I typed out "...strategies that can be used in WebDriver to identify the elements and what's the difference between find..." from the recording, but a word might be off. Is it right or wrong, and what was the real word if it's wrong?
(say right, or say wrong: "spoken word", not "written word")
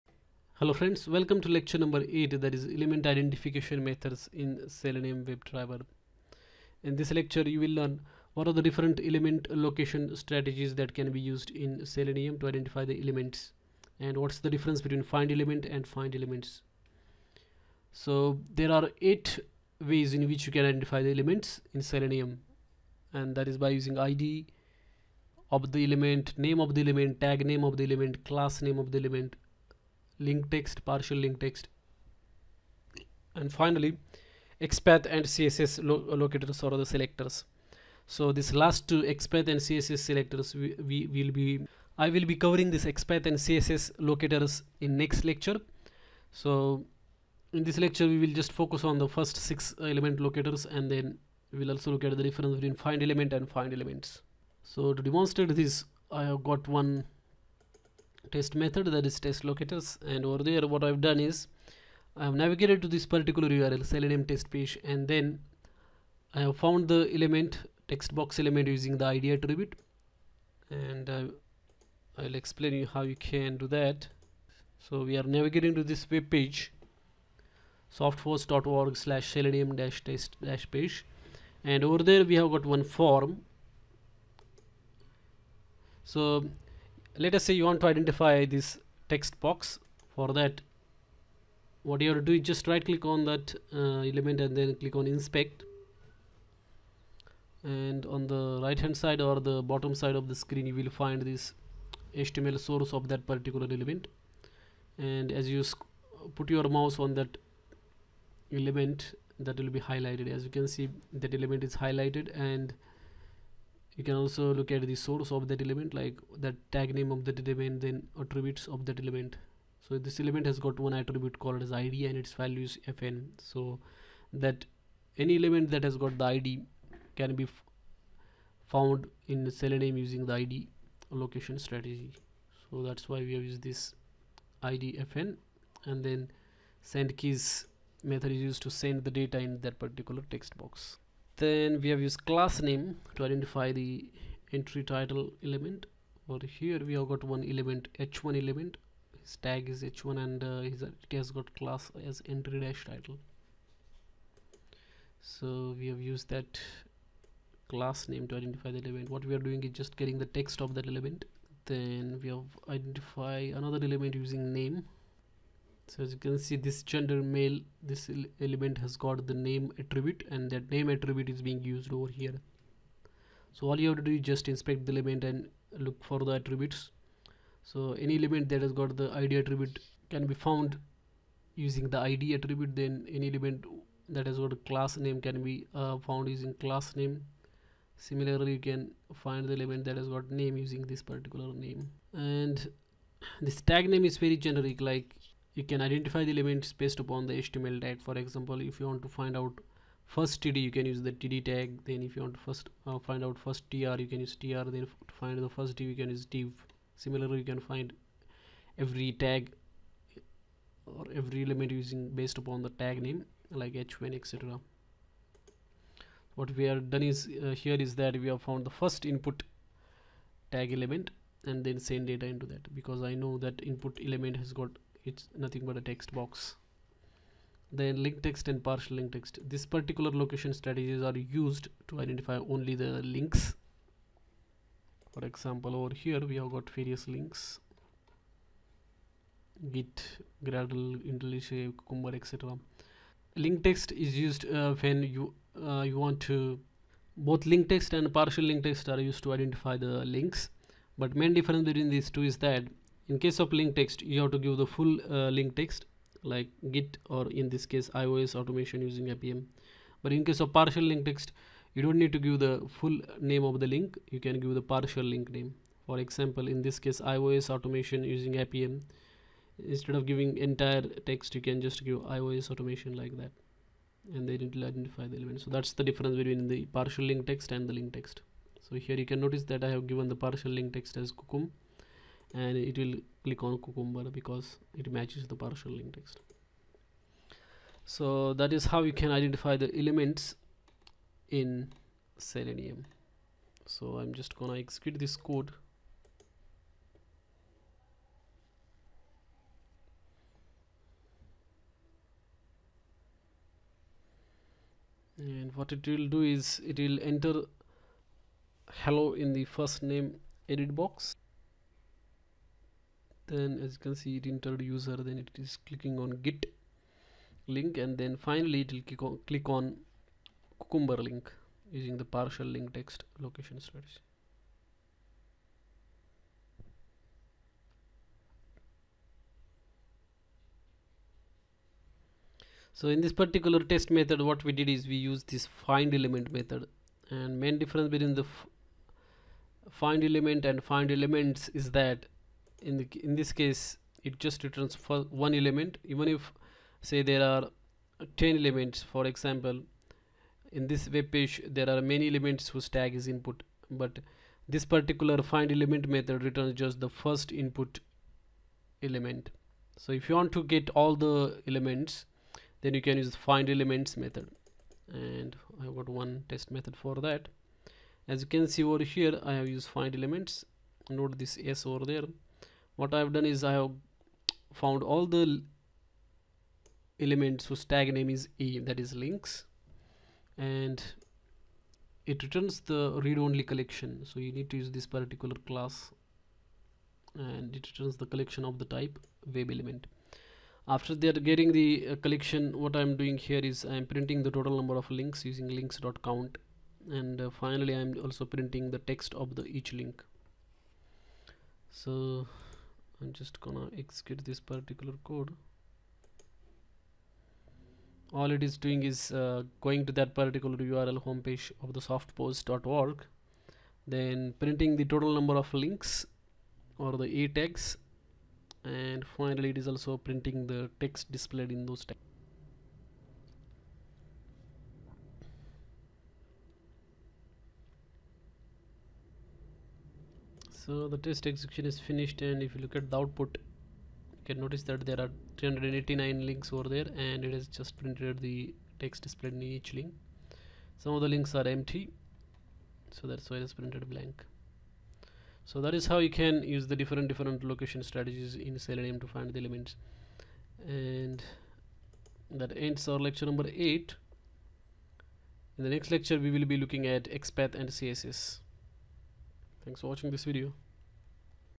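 wrong: "Selenium", not "WebDriver".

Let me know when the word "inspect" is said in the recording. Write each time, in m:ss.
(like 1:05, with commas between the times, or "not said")
1:35, 2:54.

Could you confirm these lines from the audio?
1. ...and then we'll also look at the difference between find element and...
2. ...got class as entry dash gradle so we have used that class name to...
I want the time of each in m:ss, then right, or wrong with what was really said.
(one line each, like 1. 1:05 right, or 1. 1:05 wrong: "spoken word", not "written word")
1. 0:50 right
2. 2:31 wrong: "title", not "gradle".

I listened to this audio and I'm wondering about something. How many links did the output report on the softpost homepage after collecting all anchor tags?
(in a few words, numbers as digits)
389.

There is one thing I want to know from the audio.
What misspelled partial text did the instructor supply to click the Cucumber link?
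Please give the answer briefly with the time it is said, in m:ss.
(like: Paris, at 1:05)
kukum, at 4:41.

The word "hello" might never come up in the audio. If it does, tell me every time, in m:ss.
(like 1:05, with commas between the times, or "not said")
0:00, 5:08.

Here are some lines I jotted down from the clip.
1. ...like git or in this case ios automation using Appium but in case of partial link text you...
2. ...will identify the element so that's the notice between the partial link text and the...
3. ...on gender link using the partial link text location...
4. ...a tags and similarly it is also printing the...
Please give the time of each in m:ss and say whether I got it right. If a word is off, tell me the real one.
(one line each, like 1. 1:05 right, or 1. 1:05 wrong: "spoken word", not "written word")
1. 4:16 right
2. 4:34 wrong: "difference", not "notice"
3. 5:19 wrong: "cucumber", not "gender"
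4. 6:57 wrong: "finally", not "similarly".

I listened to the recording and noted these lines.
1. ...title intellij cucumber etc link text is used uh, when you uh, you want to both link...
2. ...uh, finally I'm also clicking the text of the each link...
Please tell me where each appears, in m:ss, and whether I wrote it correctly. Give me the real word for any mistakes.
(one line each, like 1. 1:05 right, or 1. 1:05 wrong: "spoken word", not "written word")
1. 4:00 wrong: "gradle", not "title"
2. 6:37 wrong: "printing", not "clicking".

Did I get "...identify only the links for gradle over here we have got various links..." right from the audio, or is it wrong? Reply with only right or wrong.
wrong.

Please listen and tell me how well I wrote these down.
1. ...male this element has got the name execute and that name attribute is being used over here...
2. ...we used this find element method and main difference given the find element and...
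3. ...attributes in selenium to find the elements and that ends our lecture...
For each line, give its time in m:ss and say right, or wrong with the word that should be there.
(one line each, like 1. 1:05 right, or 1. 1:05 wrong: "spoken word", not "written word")
1. 2:47 wrong: "attribute", not "execute"
2. 5:34 wrong: "between", not "given"
3. 7:27 wrong: "strategies", not "attributes".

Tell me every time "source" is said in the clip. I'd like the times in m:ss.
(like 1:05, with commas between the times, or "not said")
1:42, 1:54.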